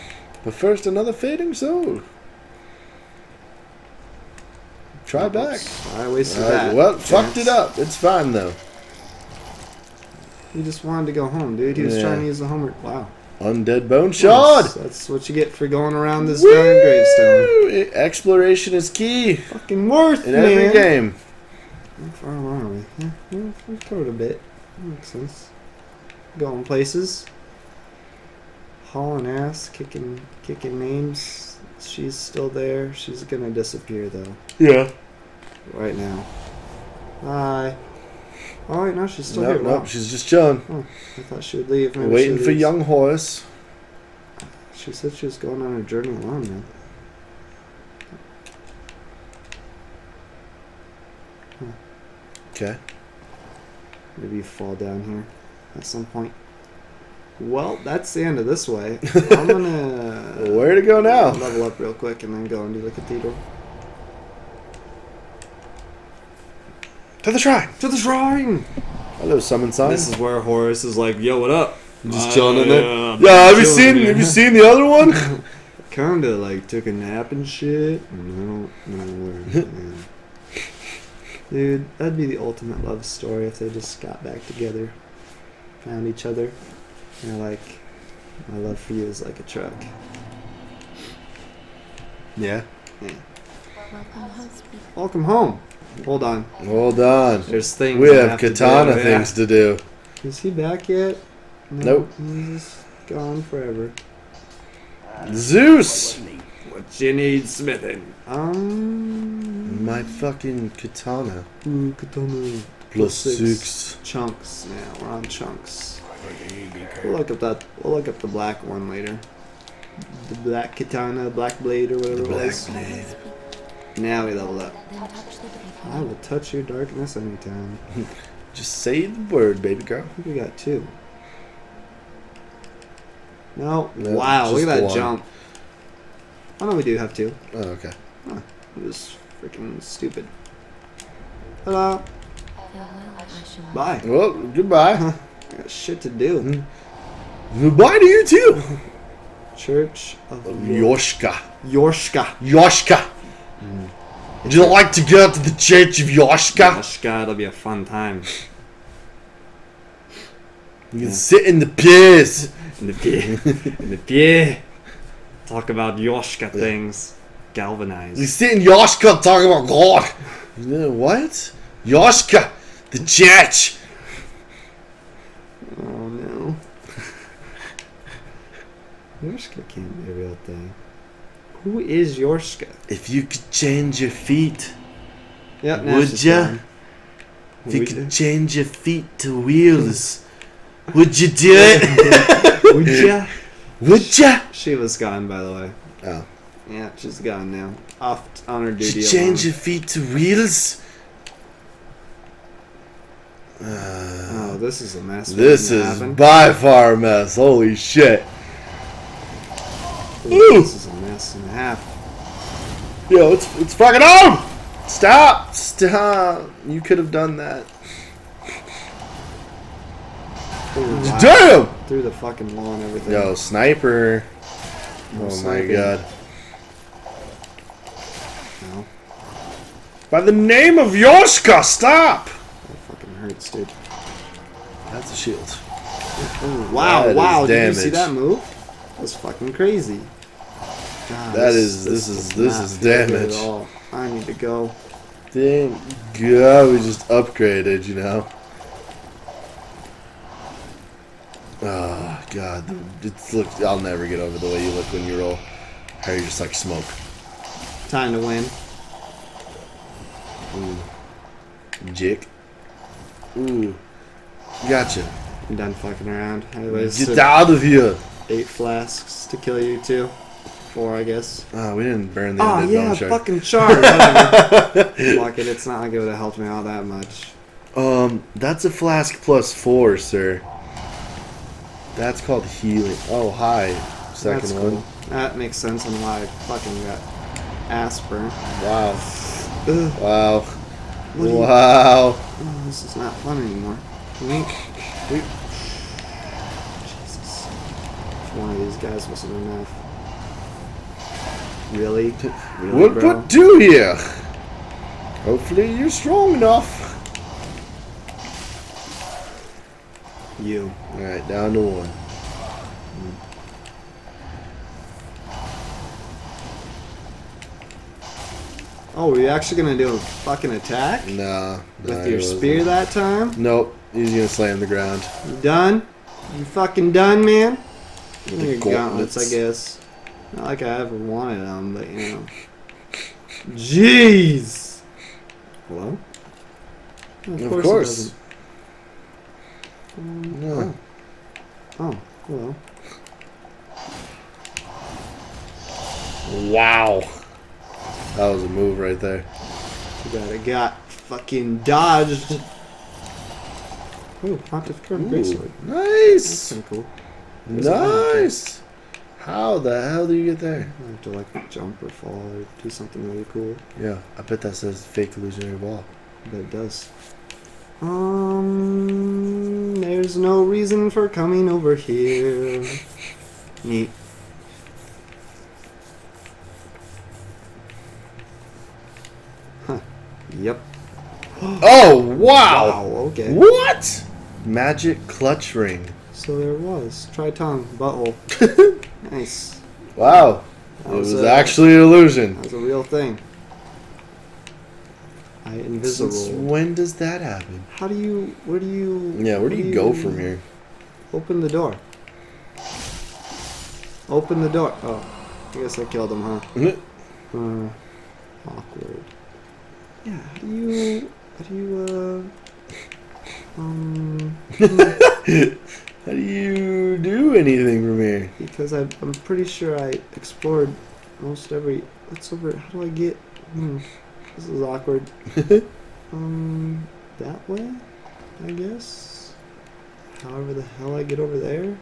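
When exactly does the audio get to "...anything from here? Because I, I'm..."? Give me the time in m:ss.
6:57.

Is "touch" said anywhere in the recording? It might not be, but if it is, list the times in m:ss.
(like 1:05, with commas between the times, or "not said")
2:06.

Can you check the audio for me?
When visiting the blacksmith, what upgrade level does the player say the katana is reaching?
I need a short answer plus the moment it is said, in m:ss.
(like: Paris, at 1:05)
+6, at 1:52.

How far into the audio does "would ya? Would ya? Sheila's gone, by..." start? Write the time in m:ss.
3:12.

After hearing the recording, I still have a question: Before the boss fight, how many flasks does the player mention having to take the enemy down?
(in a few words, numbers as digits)
8.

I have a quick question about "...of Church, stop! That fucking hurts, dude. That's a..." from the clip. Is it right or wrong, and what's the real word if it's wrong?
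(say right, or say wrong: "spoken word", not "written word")
wrong: "Yorshka", not "Church".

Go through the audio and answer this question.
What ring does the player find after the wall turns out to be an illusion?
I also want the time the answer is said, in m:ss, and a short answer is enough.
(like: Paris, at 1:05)
Magic Clutch Ring, at 6:24.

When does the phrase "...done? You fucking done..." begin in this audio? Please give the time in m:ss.
5:25.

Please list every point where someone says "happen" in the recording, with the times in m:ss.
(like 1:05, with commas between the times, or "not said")
3:25, 6:37.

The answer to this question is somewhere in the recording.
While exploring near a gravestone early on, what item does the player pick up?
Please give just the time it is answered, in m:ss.
0:13.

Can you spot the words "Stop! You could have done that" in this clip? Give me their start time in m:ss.
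3:35.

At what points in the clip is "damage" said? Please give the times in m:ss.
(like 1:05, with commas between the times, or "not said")
3:57, 4:03.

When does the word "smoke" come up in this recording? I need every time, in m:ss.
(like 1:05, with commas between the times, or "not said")
4:16.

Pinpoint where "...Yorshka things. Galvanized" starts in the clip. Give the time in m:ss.
2:45.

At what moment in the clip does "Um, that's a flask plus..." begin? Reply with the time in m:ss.
4:37.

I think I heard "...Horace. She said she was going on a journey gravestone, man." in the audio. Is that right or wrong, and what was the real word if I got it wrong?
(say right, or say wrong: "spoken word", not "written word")
wrong: "alone", not "gravestone".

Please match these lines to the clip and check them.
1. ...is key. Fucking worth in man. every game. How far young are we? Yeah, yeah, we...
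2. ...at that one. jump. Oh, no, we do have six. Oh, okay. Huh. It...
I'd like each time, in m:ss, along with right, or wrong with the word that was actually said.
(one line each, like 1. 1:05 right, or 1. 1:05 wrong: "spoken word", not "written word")
1. 0:18 wrong: "along", not "young"
2. 2:14 wrong: "two", not "six".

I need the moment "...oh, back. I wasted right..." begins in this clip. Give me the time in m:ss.
0:05.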